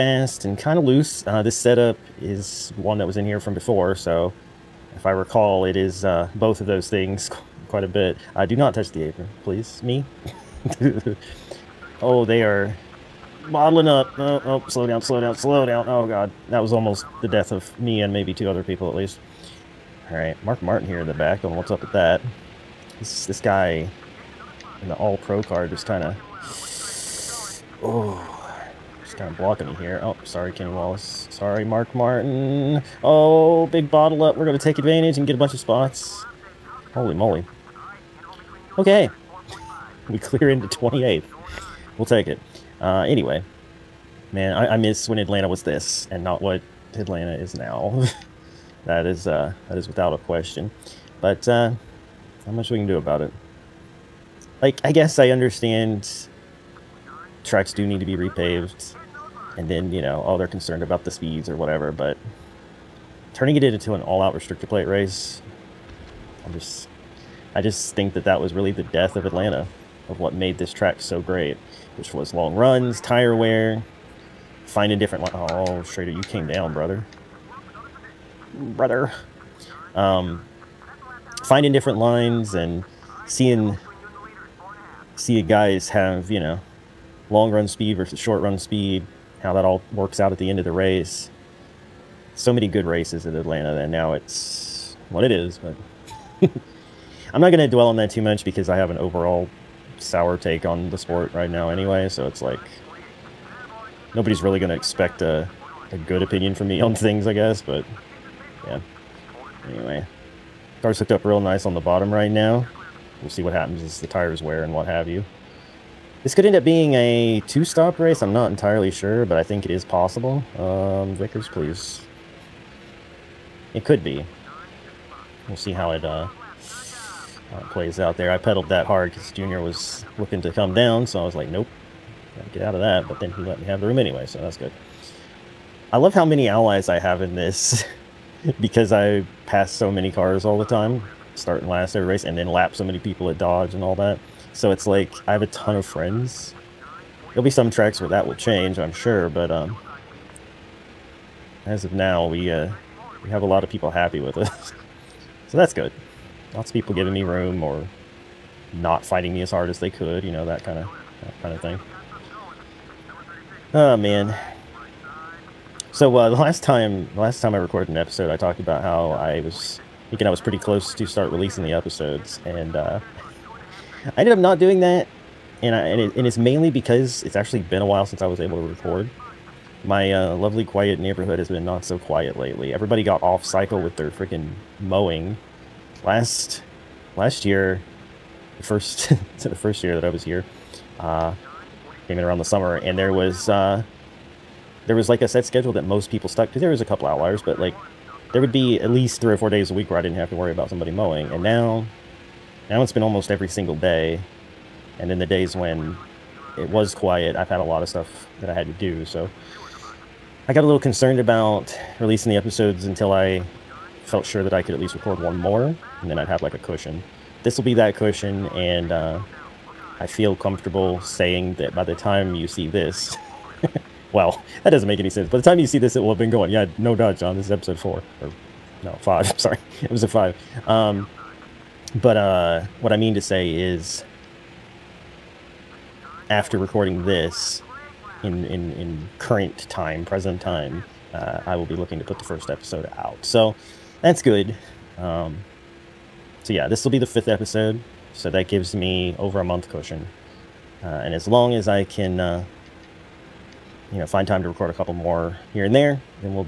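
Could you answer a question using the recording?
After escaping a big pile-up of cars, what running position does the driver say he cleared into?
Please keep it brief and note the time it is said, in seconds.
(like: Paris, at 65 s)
28th, at 40 s.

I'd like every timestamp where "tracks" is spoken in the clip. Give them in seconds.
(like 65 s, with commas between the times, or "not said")
57 s, 70 s, 147 s.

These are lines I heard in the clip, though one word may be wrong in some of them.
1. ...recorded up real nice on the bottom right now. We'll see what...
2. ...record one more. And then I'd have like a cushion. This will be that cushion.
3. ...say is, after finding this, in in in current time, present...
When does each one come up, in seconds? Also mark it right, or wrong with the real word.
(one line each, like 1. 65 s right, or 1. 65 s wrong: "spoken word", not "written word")
1. 110 s wrong: "hooked", not "recorded"
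2. 214 s right
3. 233 s wrong: "recording", not "finding".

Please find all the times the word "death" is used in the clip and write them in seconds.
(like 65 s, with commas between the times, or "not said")
17 s, 68 s.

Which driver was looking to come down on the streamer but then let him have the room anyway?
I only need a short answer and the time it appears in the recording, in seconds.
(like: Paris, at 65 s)
Junior, at 129 s.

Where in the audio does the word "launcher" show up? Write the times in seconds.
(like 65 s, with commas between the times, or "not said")
not said.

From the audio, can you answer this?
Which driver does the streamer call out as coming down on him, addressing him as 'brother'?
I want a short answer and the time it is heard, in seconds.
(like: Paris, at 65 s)
Schrader, at 75 s.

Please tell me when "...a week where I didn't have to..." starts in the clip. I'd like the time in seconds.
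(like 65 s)
199 s.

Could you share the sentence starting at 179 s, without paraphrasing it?
My uh, lovely quiet neighborhood has been not so quiet lately.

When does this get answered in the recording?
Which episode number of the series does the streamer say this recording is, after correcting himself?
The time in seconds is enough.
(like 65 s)
229 s.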